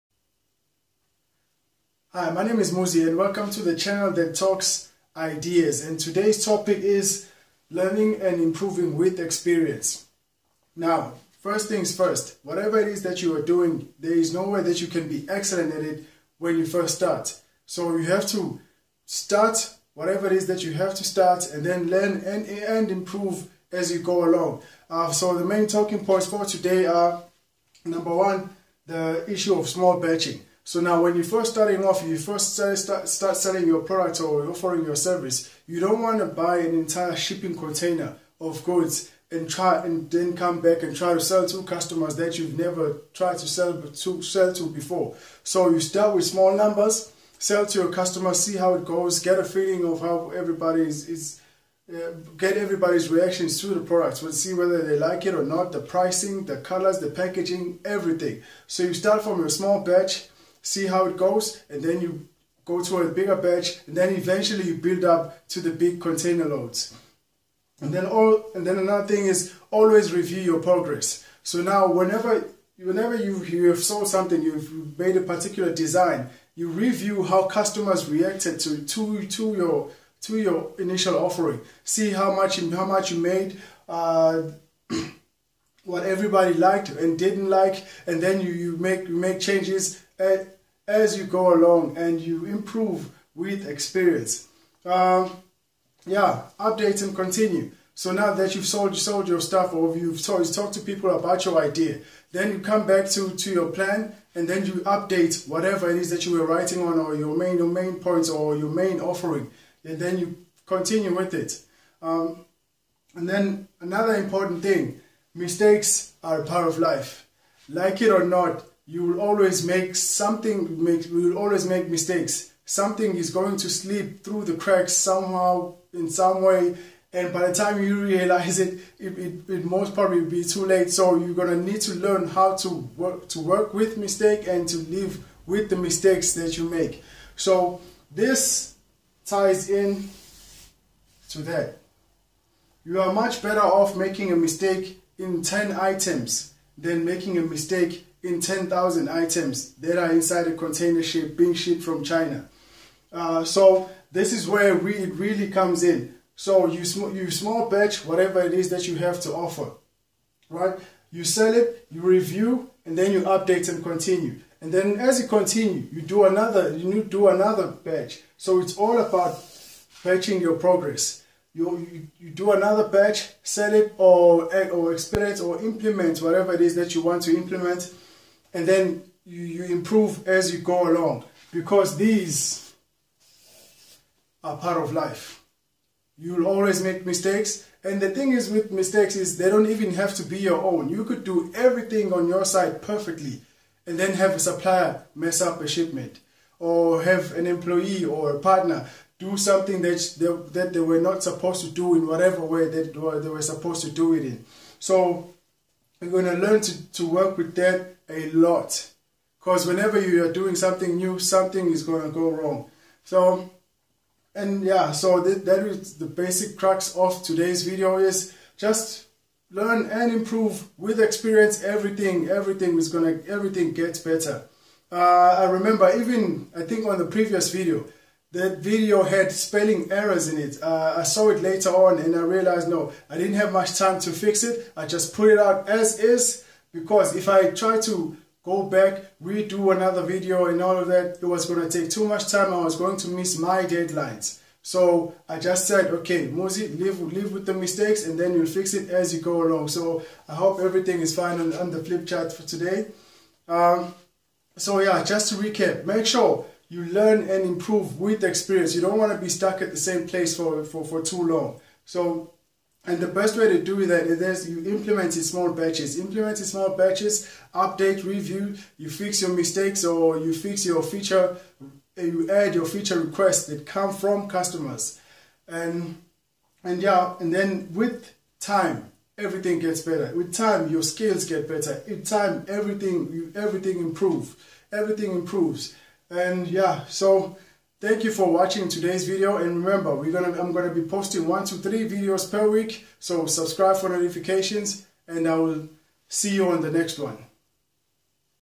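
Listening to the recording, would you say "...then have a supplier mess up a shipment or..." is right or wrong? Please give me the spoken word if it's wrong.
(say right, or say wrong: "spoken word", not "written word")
right.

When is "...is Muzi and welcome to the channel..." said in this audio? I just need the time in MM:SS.
00:02.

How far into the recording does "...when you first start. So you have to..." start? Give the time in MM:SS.
00:16.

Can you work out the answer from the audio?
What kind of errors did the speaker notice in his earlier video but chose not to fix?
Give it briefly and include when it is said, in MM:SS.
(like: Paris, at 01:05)
Spelling errors, at 03:49.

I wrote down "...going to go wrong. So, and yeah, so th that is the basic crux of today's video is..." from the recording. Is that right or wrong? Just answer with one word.
right.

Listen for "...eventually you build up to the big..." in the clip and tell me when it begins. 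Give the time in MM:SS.
01:04.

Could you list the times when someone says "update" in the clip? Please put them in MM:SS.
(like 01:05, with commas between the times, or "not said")
01:36, 01:44, 02:43, 04:27.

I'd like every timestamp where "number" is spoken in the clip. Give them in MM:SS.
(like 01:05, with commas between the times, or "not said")
00:27, 00:46.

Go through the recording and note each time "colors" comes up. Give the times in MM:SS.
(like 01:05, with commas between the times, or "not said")
00:56.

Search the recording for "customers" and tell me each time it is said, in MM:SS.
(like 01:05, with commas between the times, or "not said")
00:41, 00:47, 01:17, 04:34.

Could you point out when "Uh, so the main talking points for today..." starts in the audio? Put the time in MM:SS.
00:24.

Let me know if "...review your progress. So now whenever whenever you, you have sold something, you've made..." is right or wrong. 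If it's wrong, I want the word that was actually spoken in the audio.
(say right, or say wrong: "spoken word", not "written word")
right.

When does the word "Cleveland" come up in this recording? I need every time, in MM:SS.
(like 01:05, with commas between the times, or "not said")
not said.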